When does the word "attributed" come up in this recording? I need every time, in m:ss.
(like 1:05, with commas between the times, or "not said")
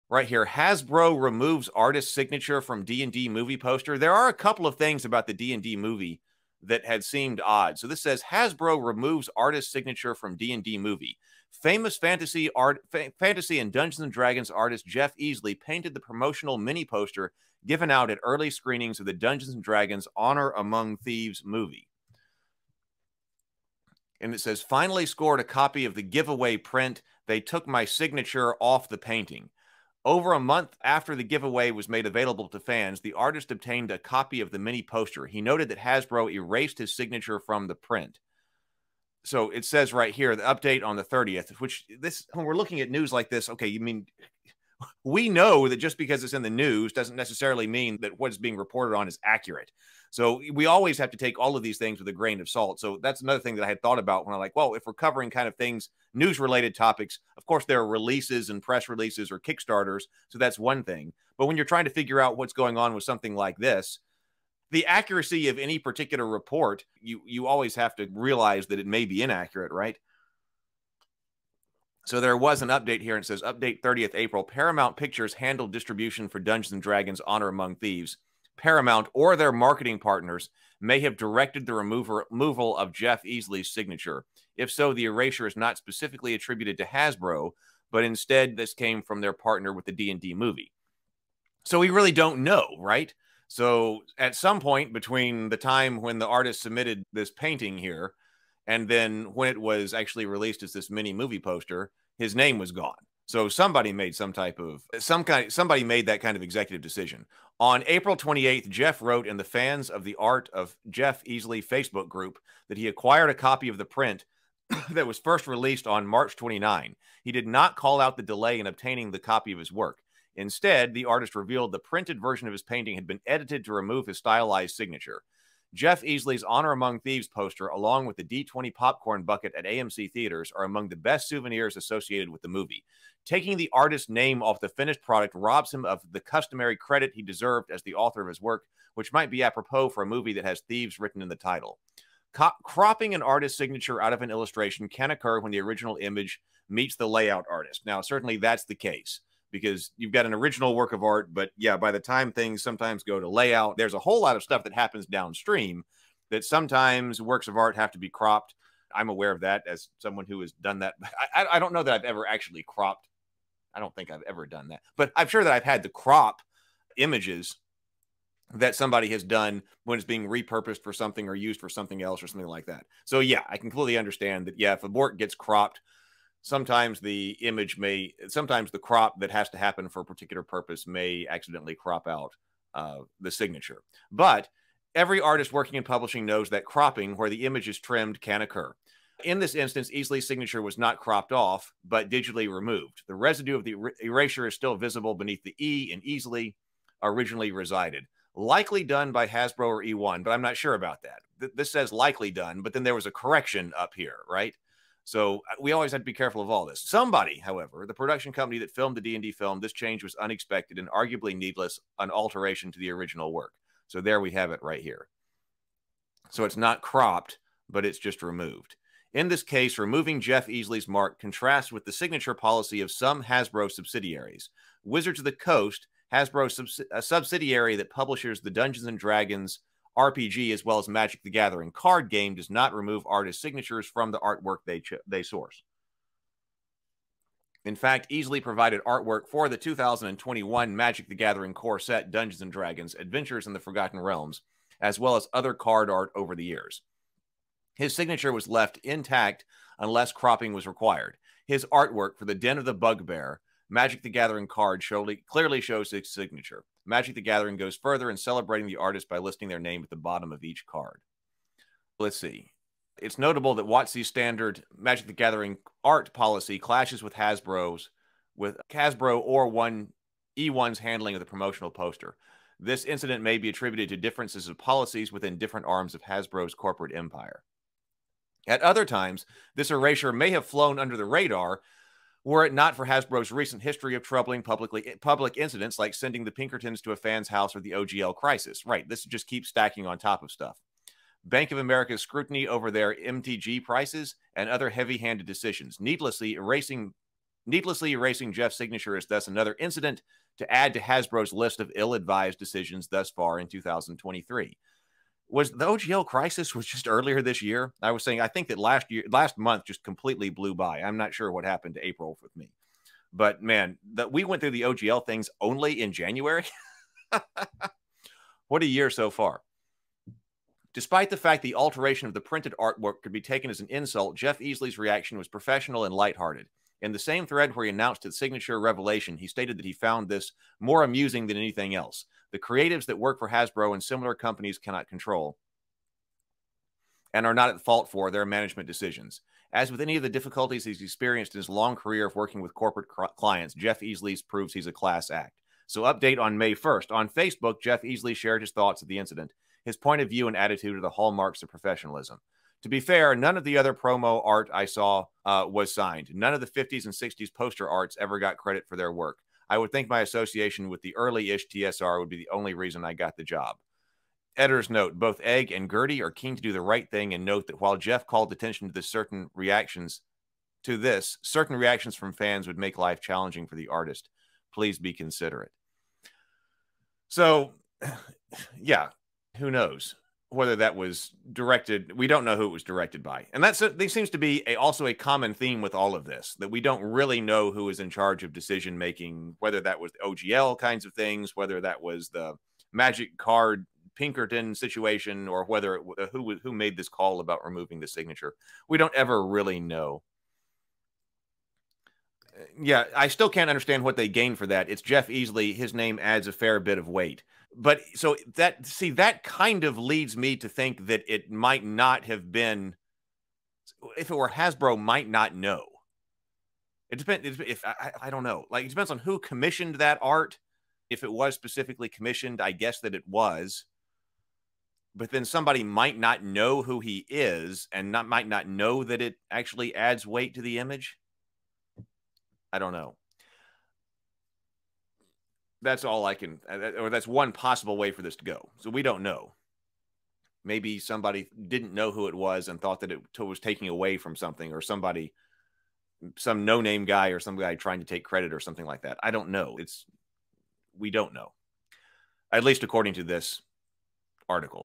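1:26, 4:33.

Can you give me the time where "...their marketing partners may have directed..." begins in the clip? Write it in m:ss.
1:19.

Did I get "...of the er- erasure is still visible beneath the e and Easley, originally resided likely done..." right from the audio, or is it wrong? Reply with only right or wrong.
right.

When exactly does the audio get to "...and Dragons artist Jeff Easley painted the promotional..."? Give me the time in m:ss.
0:14.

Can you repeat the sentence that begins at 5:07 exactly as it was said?
I was saying I think that last year, last month, just completely blew by.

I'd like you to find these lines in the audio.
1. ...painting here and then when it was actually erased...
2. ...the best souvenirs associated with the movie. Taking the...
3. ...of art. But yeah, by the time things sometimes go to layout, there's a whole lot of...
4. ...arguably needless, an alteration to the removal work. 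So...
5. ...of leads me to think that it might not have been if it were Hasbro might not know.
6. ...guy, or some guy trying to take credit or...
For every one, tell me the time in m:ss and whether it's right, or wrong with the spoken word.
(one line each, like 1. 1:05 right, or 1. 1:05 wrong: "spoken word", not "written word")
1. 1:37 wrong: "released", not "erased"
2. 2:10 right
3. 2:30 right
4. 3:30 wrong: "original", not "removal"
5. 6:49 right
6. 7:26 right.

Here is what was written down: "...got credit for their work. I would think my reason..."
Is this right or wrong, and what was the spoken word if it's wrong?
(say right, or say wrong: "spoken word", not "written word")
wrong: "association", not "reason".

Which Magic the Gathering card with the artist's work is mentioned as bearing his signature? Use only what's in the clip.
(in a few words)
Den of the Bugbear.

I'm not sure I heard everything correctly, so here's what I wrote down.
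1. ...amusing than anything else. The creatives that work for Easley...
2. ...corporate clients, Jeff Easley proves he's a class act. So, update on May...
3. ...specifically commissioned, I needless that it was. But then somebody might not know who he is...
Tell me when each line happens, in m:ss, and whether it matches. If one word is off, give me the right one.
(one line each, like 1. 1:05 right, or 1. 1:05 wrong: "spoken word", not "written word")
1. 5:30 wrong: "Hasbro", not "Easley"
2. 5:42 right
3. 7:01 wrong: "guess", not "needless".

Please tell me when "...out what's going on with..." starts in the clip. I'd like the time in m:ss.
1:02.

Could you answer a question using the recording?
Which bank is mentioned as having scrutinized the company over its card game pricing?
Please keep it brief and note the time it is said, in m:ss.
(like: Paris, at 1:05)
Bank of America, at 4:51.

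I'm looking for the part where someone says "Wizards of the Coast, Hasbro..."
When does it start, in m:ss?
3:44.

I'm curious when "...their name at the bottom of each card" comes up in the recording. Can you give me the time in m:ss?
4:19.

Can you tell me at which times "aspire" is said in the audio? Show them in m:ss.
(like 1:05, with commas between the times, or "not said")
not said.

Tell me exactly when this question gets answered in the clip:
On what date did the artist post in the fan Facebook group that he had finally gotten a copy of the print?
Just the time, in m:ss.
1:47.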